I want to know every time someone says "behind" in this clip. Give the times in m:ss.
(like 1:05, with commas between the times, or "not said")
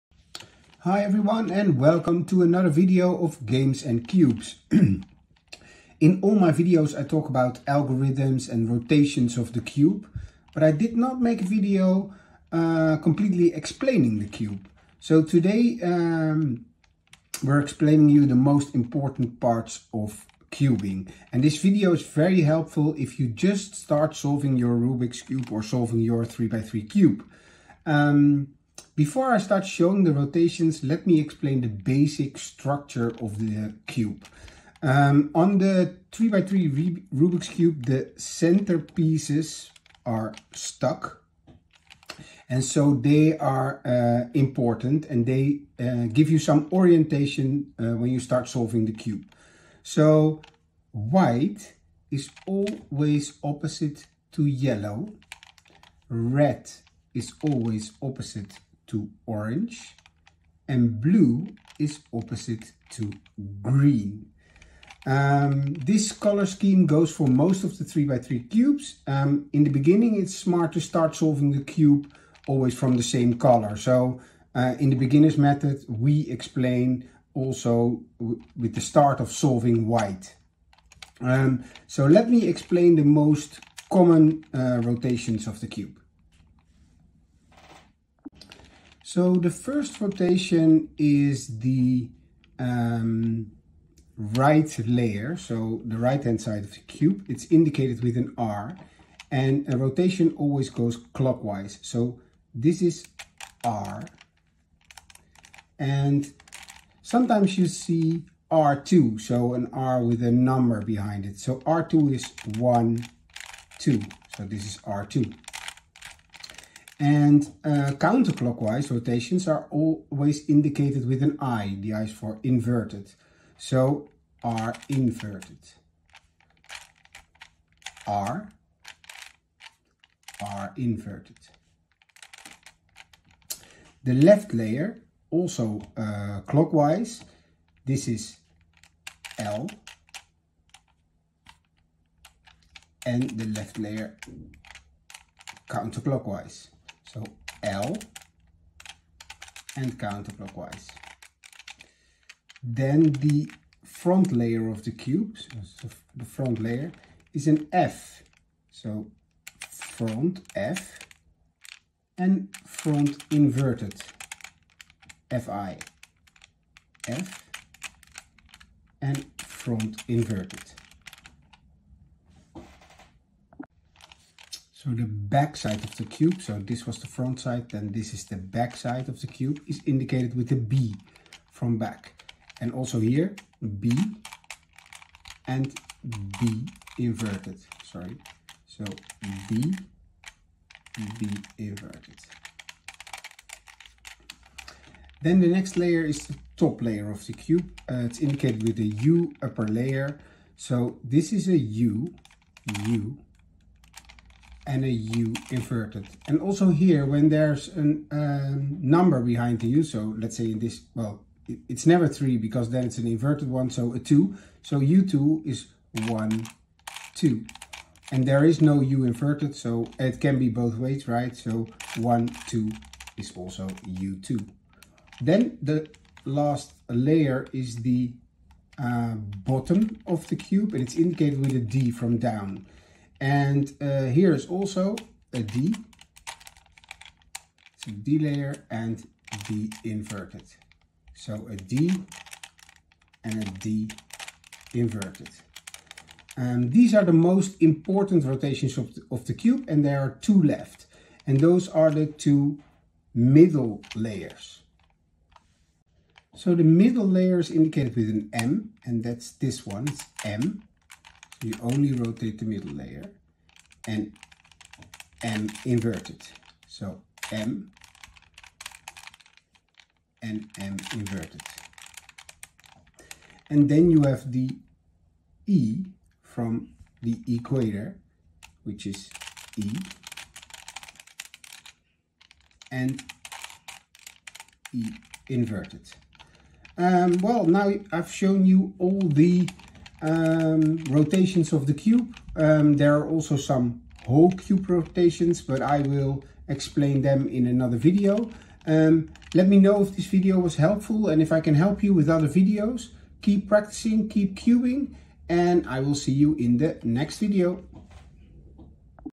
1:50, 3:29.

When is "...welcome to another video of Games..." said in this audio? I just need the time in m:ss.
0:01.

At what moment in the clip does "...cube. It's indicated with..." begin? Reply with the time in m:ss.
1:36.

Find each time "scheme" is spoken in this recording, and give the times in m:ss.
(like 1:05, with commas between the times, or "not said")
1:06.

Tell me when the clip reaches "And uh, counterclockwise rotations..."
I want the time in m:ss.
1:57.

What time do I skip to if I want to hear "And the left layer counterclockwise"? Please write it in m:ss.
2:23.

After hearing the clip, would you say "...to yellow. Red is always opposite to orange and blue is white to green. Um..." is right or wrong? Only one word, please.
wrong.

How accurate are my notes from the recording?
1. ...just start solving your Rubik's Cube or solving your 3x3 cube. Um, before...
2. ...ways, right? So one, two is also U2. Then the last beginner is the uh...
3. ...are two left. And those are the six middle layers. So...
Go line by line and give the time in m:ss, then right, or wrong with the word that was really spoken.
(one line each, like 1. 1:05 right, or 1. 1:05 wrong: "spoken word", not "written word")
1. 0:23 right
2. 3:40 wrong: "layer", not "beginner"
3. 4:09 wrong: "two", not "six".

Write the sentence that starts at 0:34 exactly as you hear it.
Um, on the 3x3 Rubik's Cube, the center pieces are stuck.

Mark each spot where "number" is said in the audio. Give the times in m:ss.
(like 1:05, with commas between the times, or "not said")
1:50, 3:28.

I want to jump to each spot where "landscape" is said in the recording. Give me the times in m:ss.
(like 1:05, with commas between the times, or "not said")
not said.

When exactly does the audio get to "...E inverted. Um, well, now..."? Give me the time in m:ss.
4:44.